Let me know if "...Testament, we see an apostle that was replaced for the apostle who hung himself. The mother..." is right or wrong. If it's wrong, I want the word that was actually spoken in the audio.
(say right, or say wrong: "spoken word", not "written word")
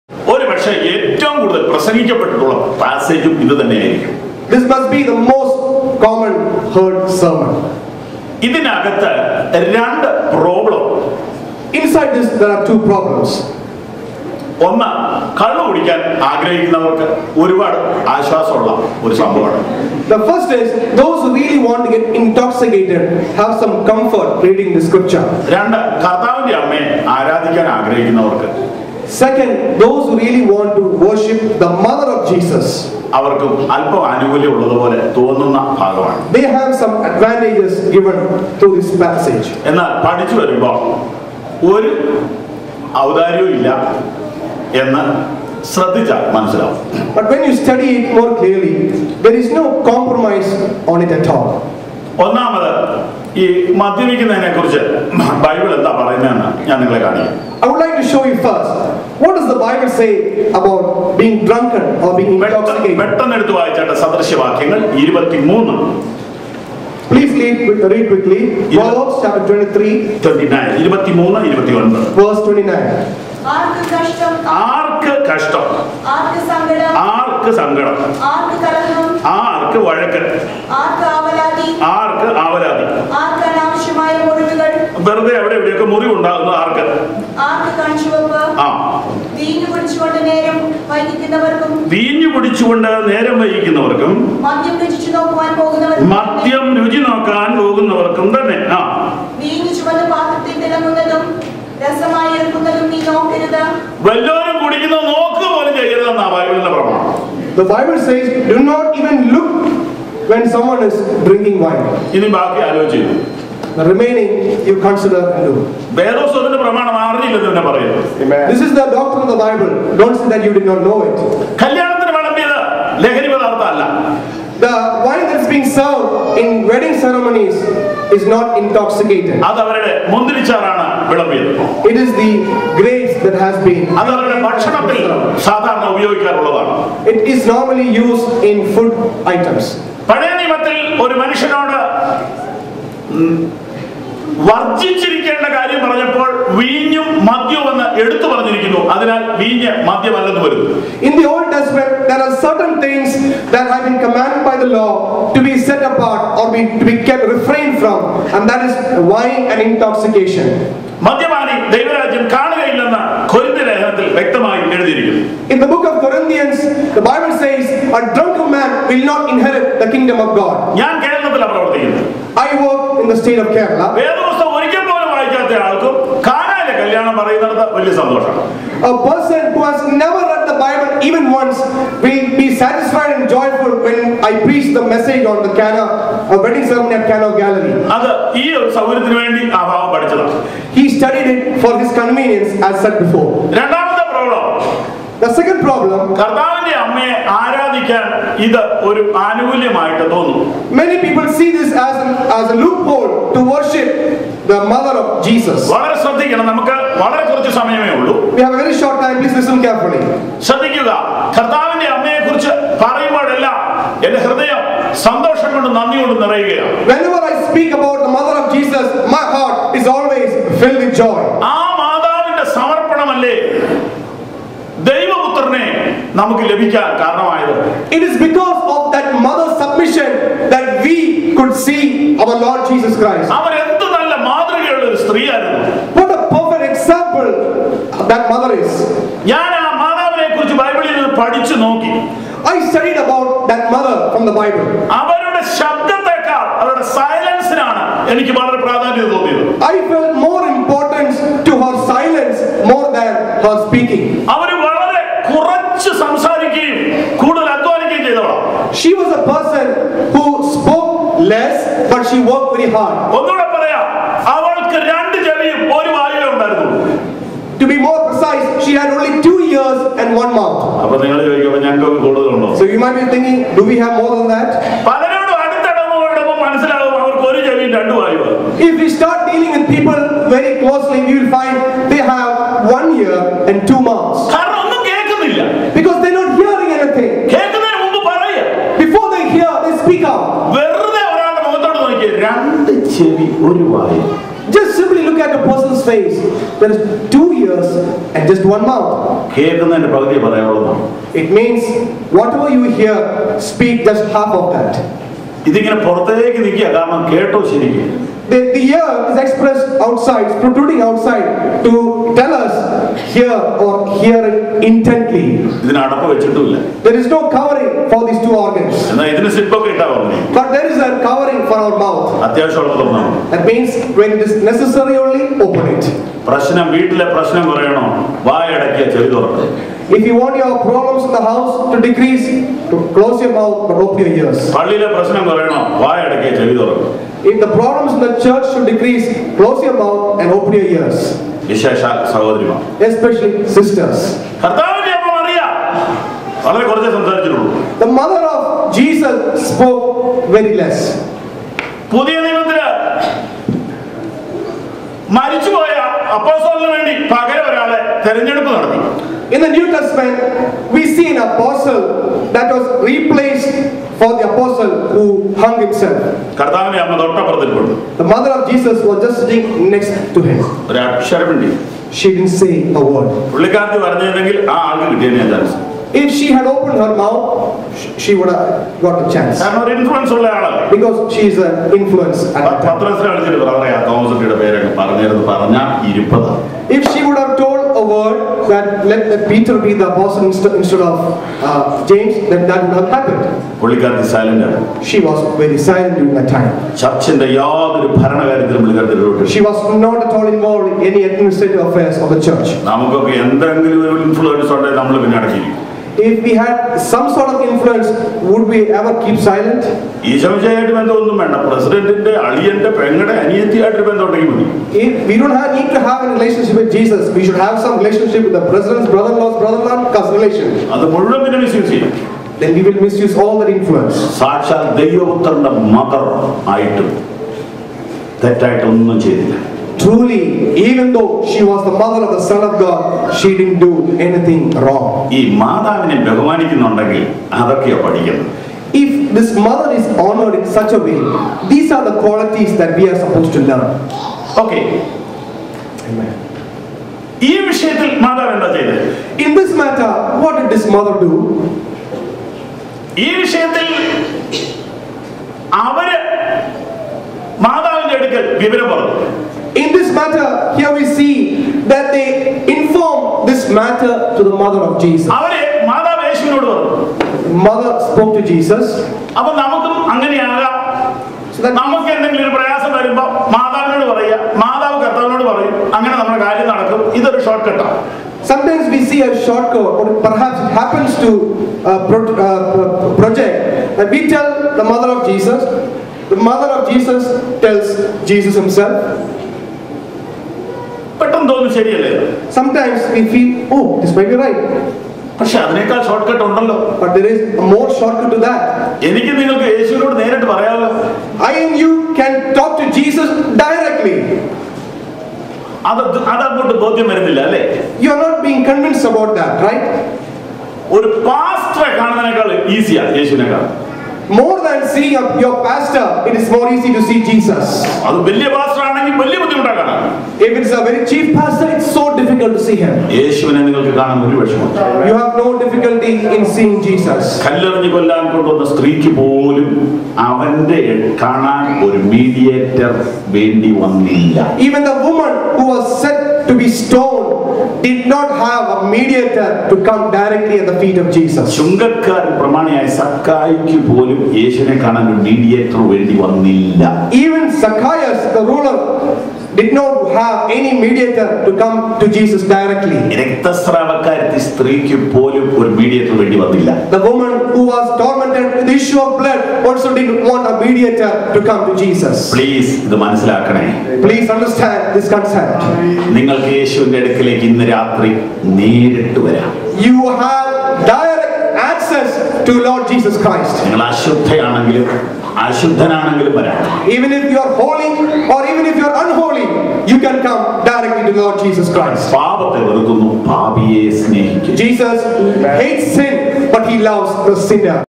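right.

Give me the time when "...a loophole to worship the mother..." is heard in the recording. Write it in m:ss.
3:22.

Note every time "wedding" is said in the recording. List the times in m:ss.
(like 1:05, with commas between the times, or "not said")
2:06, 3:06.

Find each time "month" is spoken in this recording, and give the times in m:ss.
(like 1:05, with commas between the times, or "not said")
4:30, 4:43, 4:58.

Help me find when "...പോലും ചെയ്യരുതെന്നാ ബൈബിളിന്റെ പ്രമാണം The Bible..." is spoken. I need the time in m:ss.
1:45.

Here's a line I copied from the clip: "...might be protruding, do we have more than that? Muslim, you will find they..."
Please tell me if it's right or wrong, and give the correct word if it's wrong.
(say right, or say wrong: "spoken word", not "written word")
wrong: "thinking", not "protruding".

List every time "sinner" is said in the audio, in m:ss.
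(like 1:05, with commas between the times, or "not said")
9:47.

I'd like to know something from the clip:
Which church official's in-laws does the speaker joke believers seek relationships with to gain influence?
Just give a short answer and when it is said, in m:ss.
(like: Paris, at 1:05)
The president, at 6:58.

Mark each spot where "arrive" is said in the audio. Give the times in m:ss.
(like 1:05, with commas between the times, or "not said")
not said.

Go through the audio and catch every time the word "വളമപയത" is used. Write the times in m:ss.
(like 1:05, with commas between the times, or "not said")
2:02, 2:11.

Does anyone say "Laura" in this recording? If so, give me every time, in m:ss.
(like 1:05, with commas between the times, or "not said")
not said.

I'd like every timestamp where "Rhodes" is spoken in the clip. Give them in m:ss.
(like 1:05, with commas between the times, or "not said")
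not said.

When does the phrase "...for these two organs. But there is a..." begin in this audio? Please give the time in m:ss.
5:17.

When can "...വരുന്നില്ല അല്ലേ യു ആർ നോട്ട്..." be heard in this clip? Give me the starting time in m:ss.
8:26.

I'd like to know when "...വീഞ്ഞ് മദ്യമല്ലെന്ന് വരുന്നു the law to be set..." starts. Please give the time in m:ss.
2:29.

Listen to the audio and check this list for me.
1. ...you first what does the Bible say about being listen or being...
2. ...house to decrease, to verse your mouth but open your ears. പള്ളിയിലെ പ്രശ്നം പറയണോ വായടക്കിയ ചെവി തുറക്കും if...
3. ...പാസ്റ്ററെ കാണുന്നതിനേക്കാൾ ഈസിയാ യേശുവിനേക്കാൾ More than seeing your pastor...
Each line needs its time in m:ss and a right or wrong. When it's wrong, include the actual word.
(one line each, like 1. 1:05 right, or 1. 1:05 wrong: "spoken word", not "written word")
1. 0:58 wrong: "drunken", not "listen"
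2. 5:31 wrong: "close", not "verse"
3. 8:31 right.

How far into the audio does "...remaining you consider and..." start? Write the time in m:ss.
1:53.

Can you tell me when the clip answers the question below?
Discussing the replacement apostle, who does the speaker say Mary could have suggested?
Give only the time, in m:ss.
6:29.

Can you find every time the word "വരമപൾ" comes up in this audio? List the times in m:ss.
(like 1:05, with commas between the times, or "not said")
0:40, 7:52.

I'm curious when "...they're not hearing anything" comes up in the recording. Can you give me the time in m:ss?
4:46.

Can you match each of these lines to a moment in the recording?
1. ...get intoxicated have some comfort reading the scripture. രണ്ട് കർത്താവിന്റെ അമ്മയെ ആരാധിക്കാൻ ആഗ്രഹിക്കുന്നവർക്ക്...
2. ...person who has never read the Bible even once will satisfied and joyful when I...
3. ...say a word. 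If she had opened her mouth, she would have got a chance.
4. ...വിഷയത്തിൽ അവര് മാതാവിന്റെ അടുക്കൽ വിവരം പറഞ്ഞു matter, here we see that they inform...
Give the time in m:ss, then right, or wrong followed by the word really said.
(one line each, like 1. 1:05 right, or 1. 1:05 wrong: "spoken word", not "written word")
1. 0:21 right
2. 2:59 right
3. 6:12 right
4. 7:33 right.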